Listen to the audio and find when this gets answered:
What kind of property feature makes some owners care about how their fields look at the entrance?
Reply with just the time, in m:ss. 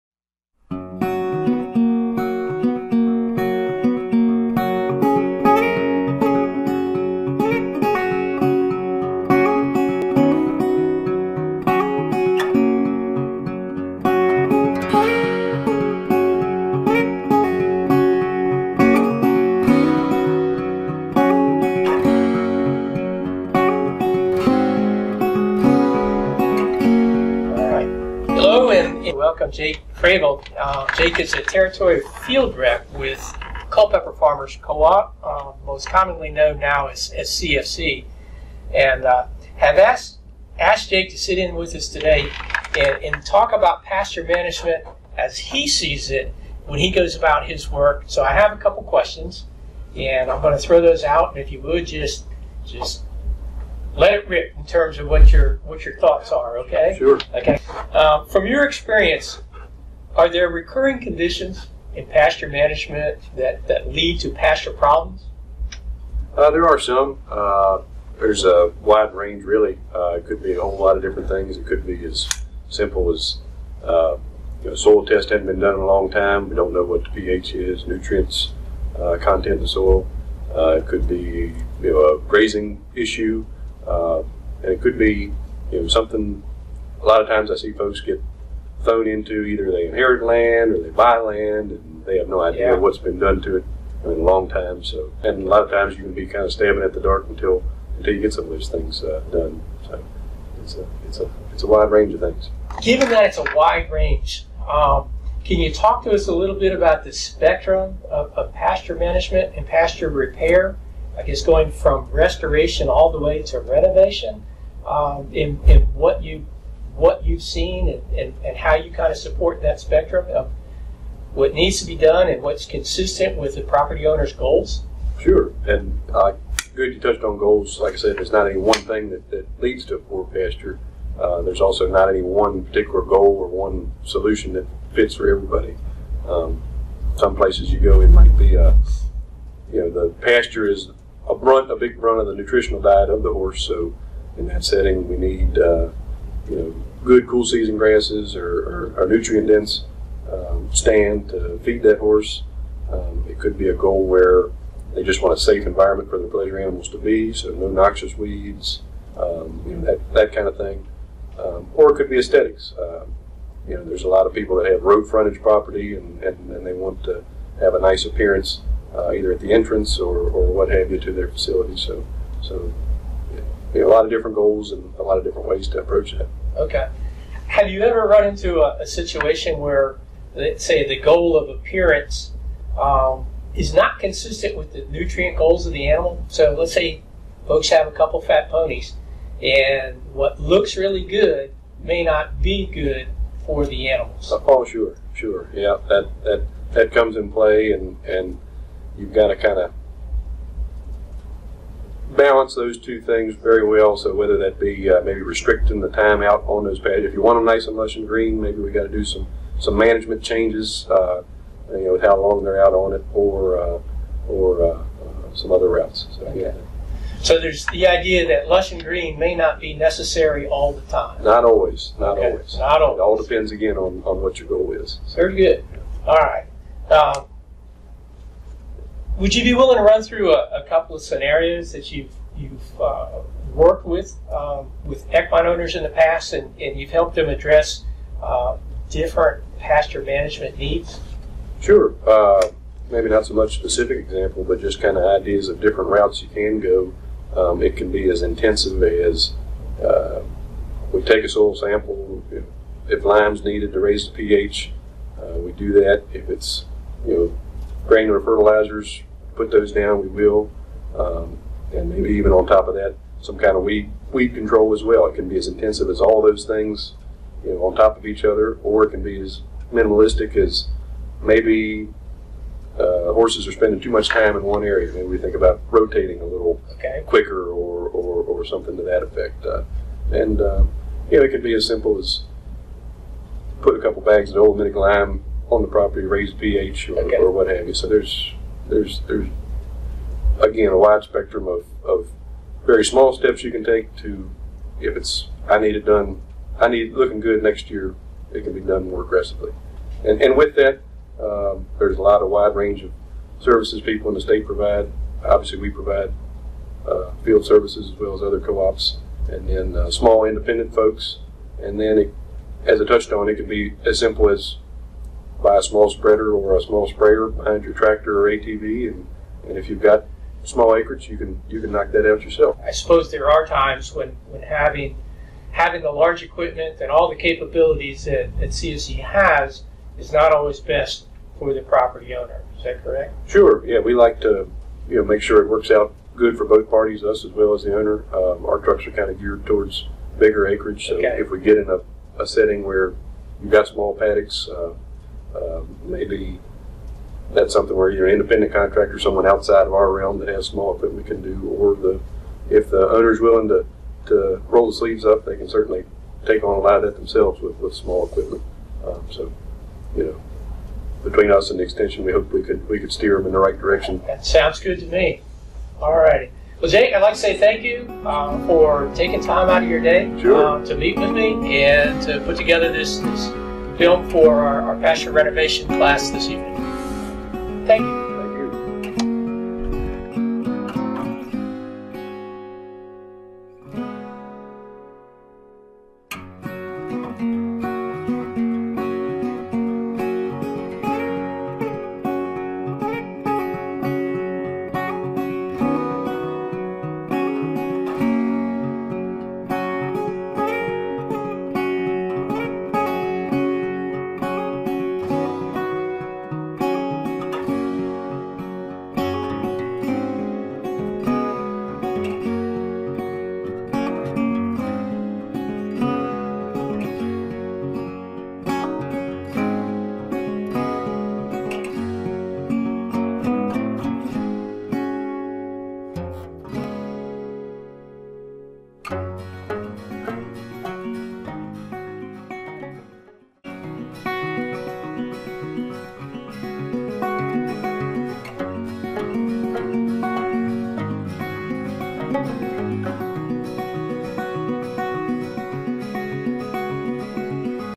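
2:44.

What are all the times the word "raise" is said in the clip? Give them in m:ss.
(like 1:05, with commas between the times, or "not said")
4:13, 4:46.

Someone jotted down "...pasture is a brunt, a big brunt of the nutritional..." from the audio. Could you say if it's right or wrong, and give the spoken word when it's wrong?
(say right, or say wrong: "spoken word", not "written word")
right.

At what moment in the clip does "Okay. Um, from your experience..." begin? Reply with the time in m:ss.
0:57.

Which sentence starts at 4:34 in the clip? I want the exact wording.
Maybe we think about rotating a little okay.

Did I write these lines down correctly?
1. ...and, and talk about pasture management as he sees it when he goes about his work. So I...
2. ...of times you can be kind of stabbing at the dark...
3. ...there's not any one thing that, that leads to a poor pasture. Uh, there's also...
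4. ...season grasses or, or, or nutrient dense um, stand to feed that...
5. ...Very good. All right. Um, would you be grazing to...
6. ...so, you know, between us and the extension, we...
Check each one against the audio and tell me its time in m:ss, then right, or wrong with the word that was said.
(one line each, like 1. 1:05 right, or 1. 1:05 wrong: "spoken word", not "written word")
1. 0:42 right
2. 1:35 right
3. 2:08 right
4. 2:27 right
5. 3:45 wrong: "willing", not "grazing"
6. 5:59 right.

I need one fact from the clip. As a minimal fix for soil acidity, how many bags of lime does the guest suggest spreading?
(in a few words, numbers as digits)
2.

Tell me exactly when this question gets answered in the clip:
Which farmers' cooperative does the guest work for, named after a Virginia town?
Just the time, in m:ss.
0:33.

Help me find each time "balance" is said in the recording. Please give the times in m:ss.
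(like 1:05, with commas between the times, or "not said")
3:22.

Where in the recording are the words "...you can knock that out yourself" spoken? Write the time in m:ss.
5:21.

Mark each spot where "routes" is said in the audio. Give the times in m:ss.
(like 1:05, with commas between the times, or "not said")
3:35, 4:05.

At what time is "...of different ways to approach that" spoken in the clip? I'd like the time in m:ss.
2:55.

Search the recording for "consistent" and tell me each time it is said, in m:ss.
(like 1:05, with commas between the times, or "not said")
2:02, 3:03.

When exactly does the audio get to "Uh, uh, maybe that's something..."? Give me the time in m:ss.
5:44.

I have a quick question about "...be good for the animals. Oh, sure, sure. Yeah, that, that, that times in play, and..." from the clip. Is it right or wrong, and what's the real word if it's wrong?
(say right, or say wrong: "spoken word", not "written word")
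wrong: "comes", not "times".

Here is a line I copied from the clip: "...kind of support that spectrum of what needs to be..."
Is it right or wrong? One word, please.
right.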